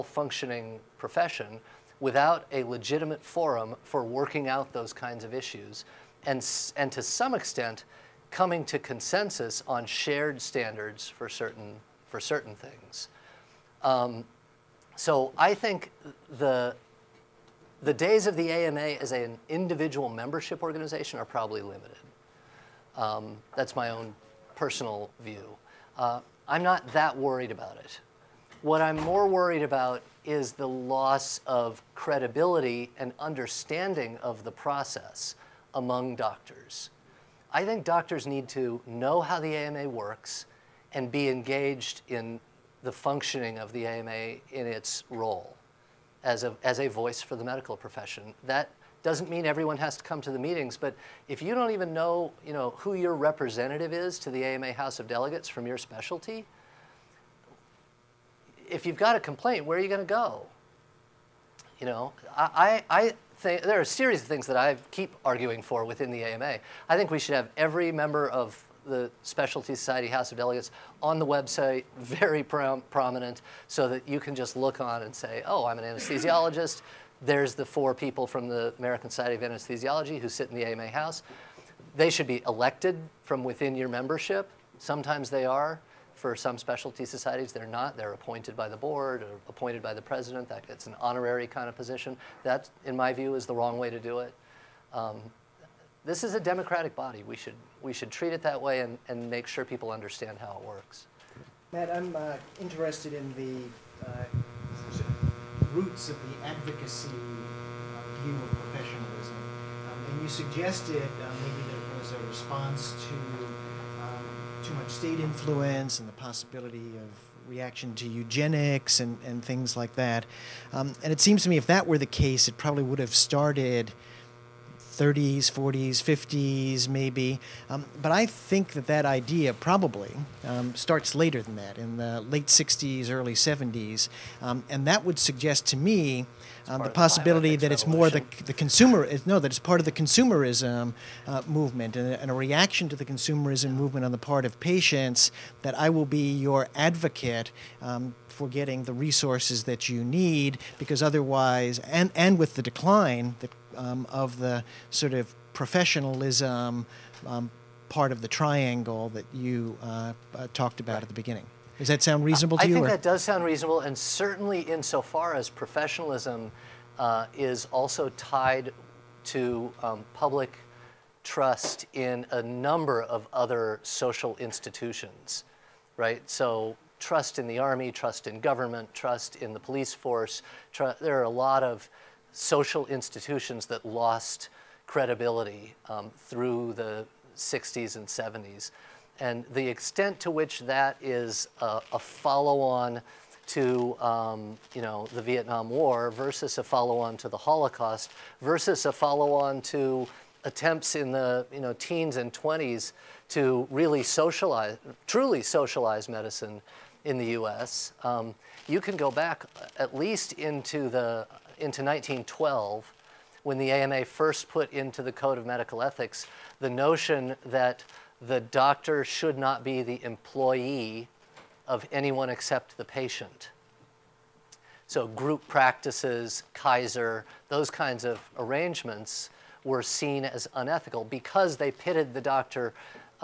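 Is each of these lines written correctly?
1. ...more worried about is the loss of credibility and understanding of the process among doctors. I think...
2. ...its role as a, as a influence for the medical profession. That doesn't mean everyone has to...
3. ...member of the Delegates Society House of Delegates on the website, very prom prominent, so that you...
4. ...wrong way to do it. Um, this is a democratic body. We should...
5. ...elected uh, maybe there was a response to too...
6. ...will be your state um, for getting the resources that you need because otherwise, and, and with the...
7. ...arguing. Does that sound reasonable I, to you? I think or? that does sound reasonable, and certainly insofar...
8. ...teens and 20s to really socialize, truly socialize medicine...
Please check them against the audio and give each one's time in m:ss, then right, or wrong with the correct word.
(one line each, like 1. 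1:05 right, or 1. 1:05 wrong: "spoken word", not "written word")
1. 0:28 right
2. 0:44 wrong: "voice", not "influence"
3. 1:07 wrong: "Specialty", not "Delegates"
4. 1:33 right
5. 1:50 wrong: "suggested", not "elected"
6. 2:25 wrong: "advocate", not "state"
7. 2:41 wrong: "beginning", not "arguing"
8. 3:21 right.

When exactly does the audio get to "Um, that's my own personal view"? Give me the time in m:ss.
0:22.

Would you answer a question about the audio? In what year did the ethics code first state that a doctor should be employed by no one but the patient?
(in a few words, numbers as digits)
1912.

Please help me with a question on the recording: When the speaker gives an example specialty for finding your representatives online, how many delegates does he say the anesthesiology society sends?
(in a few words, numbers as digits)
4.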